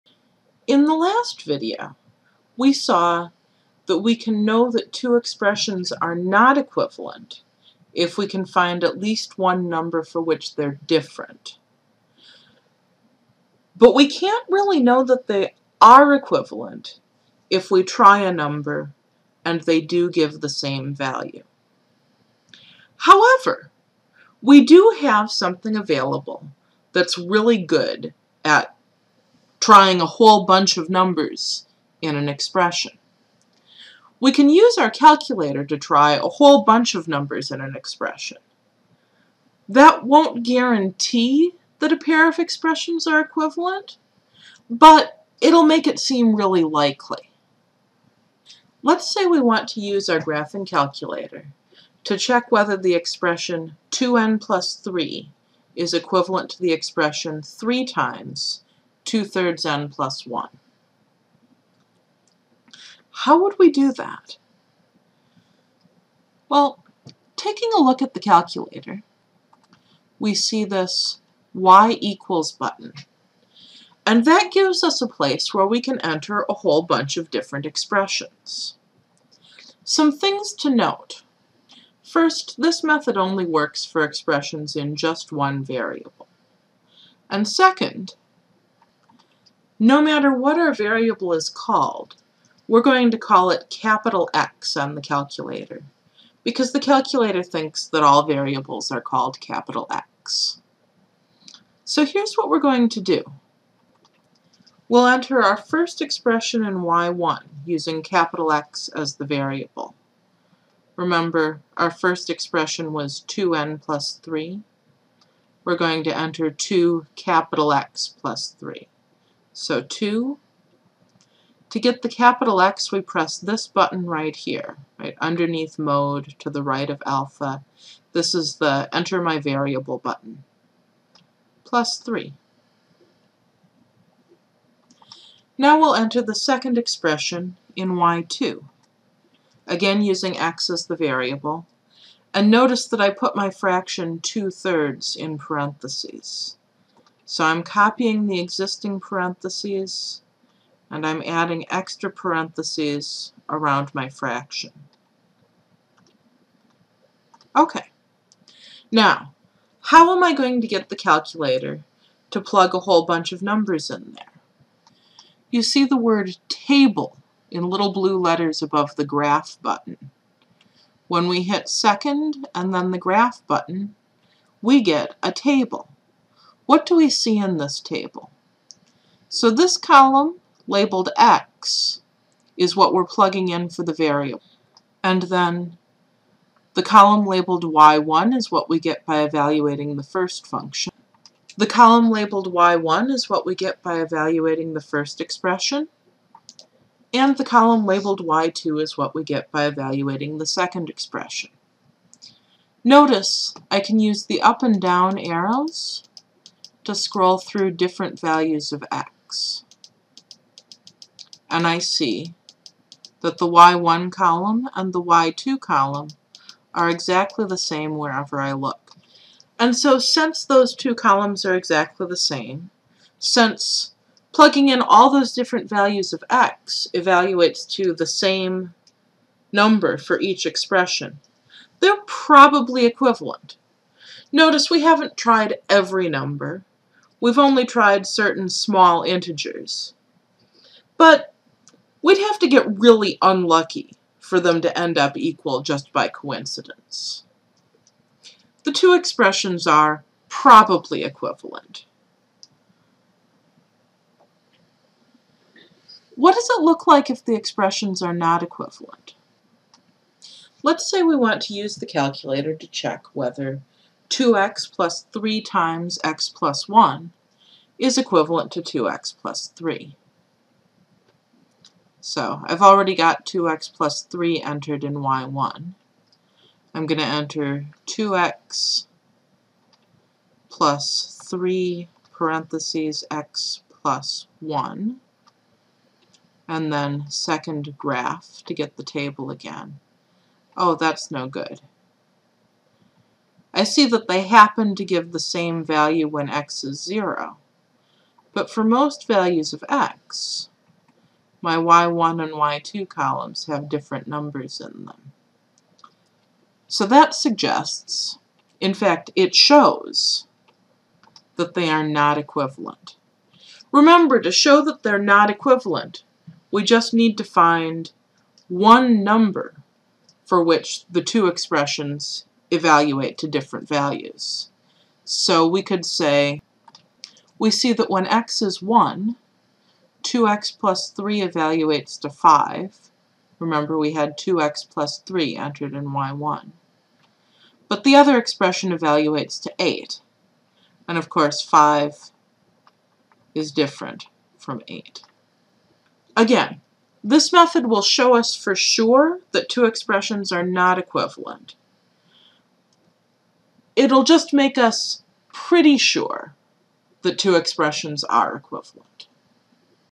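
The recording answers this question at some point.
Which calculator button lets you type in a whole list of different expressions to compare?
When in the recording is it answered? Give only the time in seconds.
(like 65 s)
71 s.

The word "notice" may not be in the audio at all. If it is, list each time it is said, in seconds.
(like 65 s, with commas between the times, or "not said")
142 s, 202 s, 234 s.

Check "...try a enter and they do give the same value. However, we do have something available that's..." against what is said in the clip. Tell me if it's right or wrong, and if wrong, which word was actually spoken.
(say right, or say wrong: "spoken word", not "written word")
wrong: "number", not "enter".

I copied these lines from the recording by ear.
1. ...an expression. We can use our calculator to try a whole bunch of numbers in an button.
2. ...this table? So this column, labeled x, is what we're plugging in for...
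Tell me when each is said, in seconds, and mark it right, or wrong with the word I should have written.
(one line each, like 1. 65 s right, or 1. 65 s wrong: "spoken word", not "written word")
1. 32 s wrong: "expression", not "button"
2. 177 s right.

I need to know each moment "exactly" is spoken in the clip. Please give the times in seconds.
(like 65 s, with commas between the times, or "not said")
216 s, 221 s.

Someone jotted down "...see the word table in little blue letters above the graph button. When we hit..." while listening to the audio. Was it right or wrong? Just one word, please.
right.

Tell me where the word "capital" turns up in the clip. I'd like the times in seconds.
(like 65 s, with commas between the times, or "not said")
93 s, 99 s, 108 s, 117 s, 122 s.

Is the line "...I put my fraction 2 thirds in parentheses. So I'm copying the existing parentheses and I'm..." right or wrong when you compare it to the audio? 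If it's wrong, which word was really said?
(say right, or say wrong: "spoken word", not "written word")
right.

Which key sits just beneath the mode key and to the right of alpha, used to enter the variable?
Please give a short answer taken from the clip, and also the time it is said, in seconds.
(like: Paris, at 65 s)
enter my variable button, at 128 s.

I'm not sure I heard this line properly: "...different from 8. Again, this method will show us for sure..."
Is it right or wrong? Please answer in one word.
right.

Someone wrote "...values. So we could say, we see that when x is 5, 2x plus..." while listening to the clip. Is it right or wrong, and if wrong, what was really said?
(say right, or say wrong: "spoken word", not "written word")
wrong: "1", not "5".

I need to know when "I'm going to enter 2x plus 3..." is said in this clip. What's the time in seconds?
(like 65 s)
276 s.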